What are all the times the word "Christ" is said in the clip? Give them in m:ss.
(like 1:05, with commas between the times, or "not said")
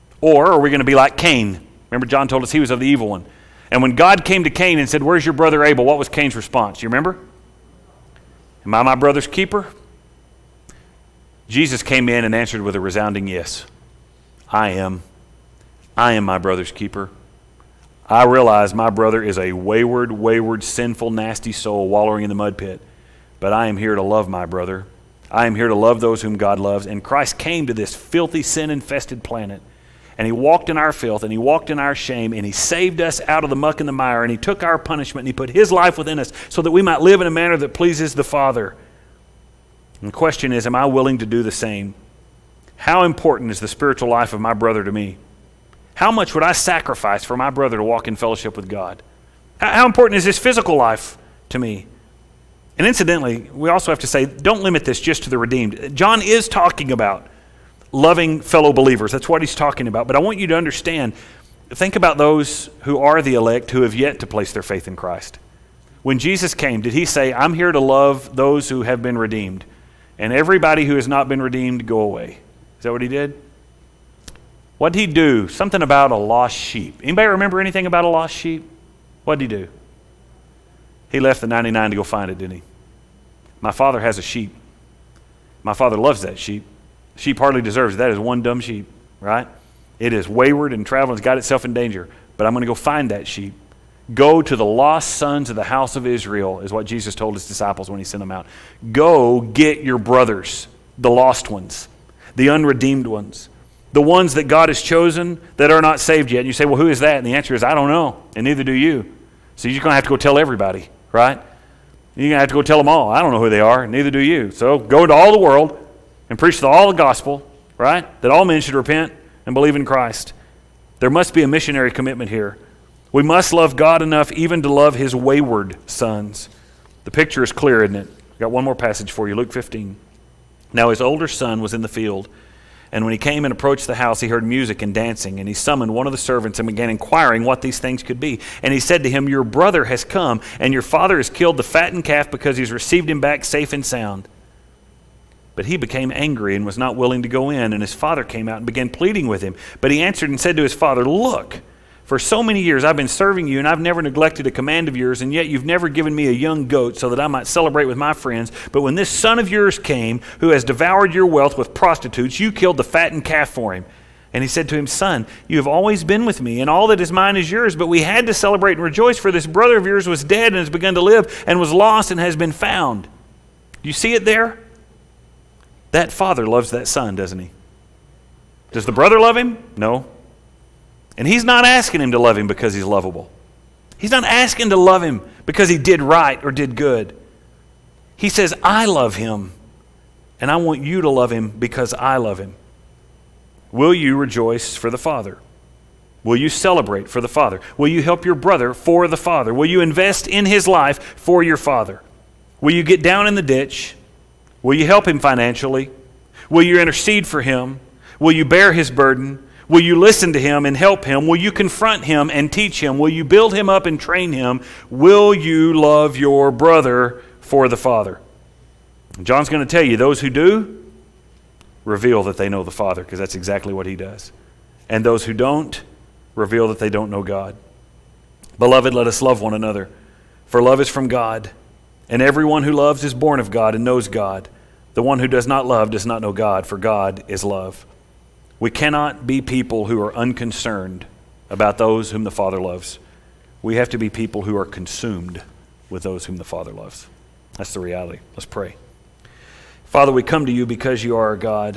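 0:27, 1:04, 1:59.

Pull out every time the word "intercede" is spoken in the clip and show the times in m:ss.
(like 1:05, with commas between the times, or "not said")
3:26.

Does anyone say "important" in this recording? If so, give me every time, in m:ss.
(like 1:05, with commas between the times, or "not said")
0:43, 0:49.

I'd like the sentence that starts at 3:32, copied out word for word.
Will you build him up and train him?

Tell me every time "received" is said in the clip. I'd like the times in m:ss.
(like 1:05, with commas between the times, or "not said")
2:22.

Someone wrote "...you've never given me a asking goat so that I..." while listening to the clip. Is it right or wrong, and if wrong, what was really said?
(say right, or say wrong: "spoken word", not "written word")
wrong: "young", not "asking".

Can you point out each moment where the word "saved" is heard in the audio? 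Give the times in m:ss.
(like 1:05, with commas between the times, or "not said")
0:32, 1:45.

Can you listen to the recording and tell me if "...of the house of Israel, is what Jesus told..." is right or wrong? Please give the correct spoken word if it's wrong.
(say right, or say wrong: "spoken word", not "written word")
right.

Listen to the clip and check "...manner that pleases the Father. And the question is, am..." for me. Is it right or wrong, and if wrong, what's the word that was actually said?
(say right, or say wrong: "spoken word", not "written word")
right.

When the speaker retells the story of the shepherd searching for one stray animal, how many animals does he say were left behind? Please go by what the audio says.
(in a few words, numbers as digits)
99.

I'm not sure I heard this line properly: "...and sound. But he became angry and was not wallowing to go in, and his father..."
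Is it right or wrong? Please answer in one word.
wrong.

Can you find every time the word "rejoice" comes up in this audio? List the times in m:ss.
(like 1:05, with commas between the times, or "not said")
2:48, 3:14.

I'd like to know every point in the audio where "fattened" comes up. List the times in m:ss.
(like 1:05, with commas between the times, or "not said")
2:21, 2:42.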